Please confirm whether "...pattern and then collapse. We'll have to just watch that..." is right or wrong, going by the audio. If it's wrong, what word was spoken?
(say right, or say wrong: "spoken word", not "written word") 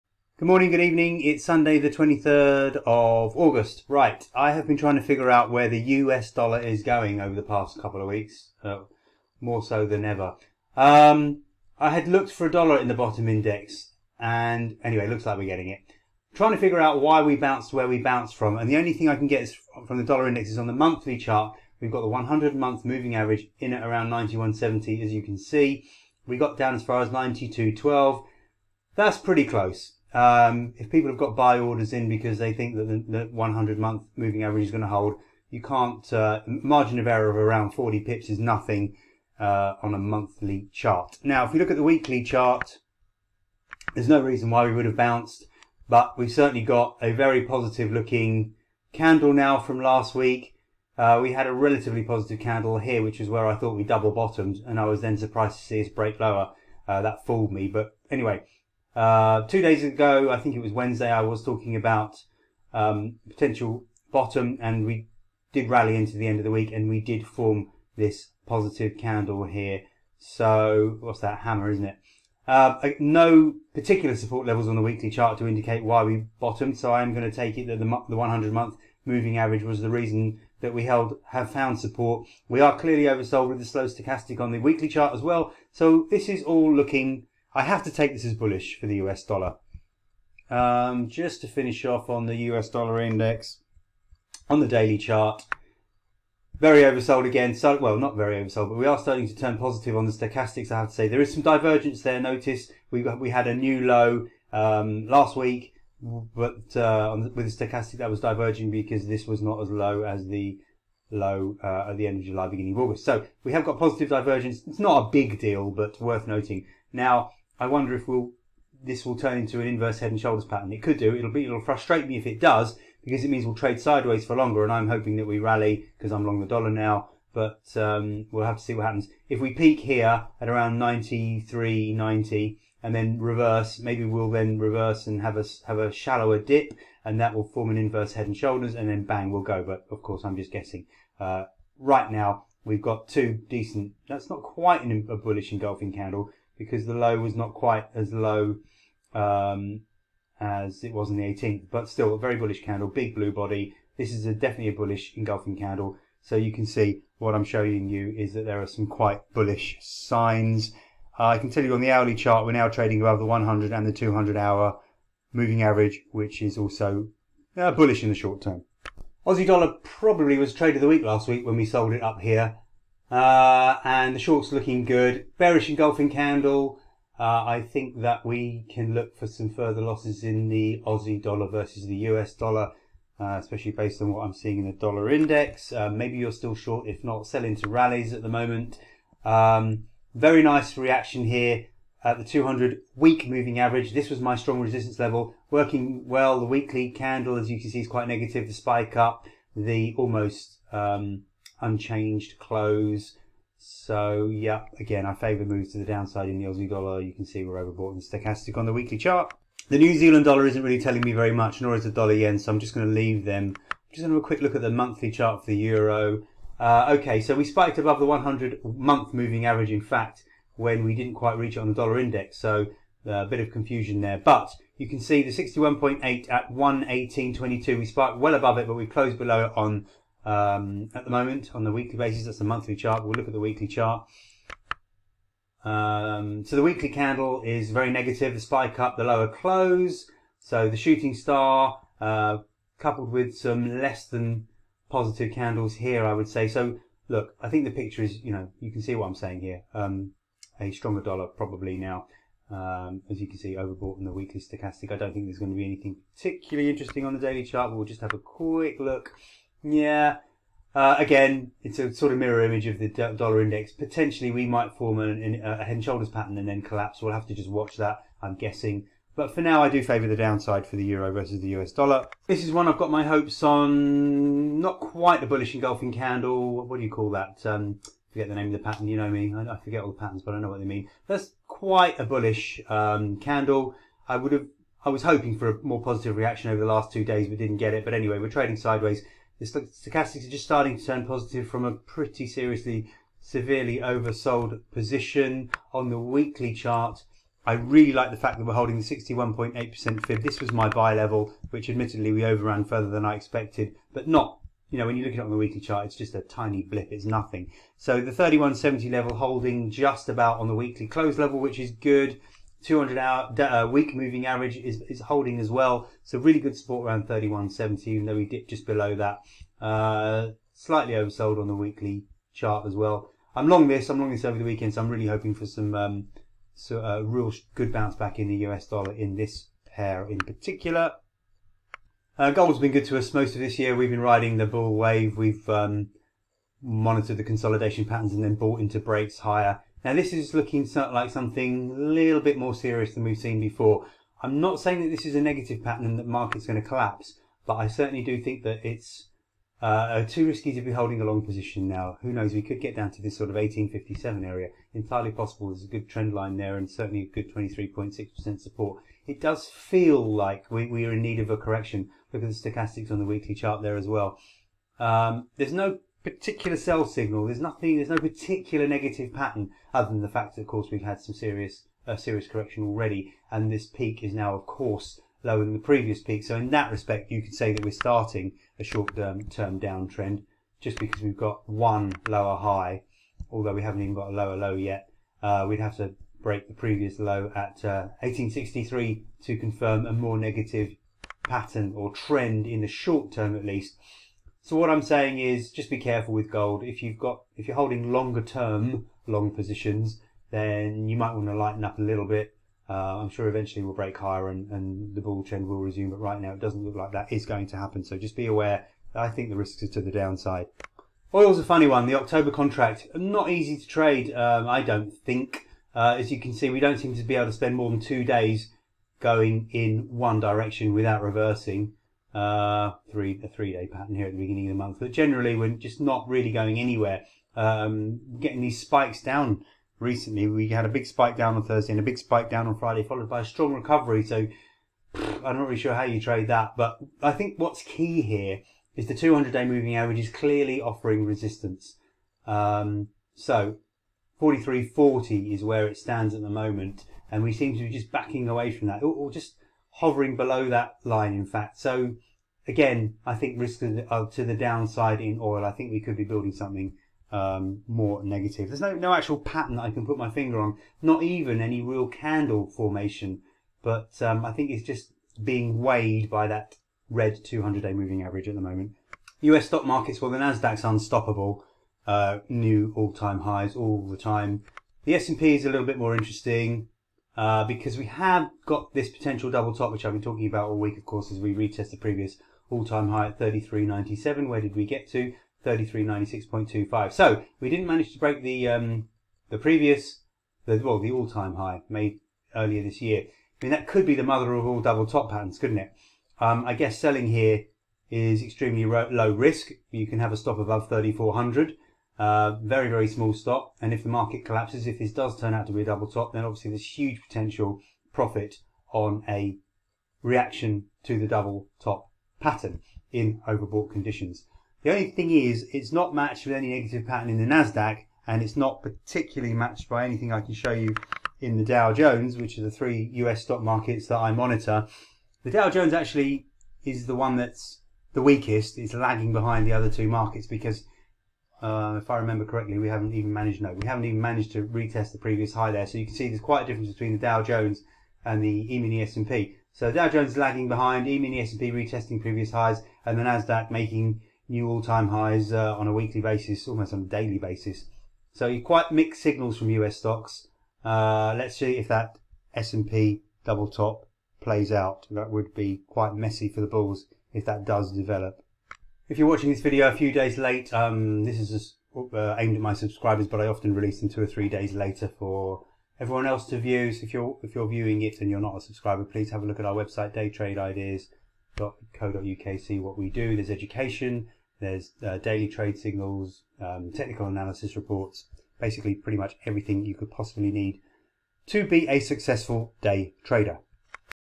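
right.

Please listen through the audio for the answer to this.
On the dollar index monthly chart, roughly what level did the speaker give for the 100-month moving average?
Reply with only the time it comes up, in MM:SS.
00:24.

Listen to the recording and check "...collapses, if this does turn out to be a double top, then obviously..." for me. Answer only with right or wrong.
right.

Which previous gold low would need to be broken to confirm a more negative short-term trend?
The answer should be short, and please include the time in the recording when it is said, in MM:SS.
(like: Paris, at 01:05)
1863, at 06:28.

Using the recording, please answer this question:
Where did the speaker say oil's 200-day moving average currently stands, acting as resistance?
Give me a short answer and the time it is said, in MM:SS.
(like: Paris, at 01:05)
43.40, at 07:24.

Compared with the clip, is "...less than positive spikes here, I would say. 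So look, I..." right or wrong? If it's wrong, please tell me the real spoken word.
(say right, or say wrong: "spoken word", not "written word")
wrong: "candles", not "spikes".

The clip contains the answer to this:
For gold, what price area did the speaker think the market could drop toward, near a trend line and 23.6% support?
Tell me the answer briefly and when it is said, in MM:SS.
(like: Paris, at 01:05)
1857, at 05:53.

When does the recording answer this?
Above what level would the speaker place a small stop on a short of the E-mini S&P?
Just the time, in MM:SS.
08:20.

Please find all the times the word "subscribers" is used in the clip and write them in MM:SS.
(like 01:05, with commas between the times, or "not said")
09:22, 09:28.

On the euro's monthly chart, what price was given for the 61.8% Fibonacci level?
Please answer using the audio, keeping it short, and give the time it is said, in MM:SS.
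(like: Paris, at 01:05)
118.22, at 03:46.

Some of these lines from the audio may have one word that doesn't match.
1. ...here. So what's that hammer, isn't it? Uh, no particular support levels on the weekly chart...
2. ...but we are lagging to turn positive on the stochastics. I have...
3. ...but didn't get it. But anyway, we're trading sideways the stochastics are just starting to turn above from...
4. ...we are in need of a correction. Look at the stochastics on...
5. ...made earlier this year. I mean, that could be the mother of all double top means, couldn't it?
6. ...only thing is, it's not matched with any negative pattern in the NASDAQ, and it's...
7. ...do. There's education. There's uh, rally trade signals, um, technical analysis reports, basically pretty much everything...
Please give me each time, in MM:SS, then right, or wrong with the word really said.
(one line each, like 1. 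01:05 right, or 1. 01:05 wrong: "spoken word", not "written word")
1. 01:09 right
2. 01:38 wrong: "starting", not "lagging"
3. 04:47 wrong: "positive", not "above"
4. 06:00 right
5. 08:11 wrong: "patterns", not "means"
6. 08:34 right
7. 09:32 wrong: "daily", not "rally".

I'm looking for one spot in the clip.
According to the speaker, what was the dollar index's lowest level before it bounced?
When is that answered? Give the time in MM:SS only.
00:27.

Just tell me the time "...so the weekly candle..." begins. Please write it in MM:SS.
03:56.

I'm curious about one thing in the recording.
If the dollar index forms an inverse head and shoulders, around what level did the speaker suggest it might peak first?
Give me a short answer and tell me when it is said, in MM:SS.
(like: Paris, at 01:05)
93.90, at 02:10.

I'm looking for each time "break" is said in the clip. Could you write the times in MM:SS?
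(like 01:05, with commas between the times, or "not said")
00:55, 05:38, 06:26, 06:43, 08:07.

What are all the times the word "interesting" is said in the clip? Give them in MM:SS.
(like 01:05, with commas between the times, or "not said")
04:16, 07:55.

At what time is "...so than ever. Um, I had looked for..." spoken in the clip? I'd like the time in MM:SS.
00:09.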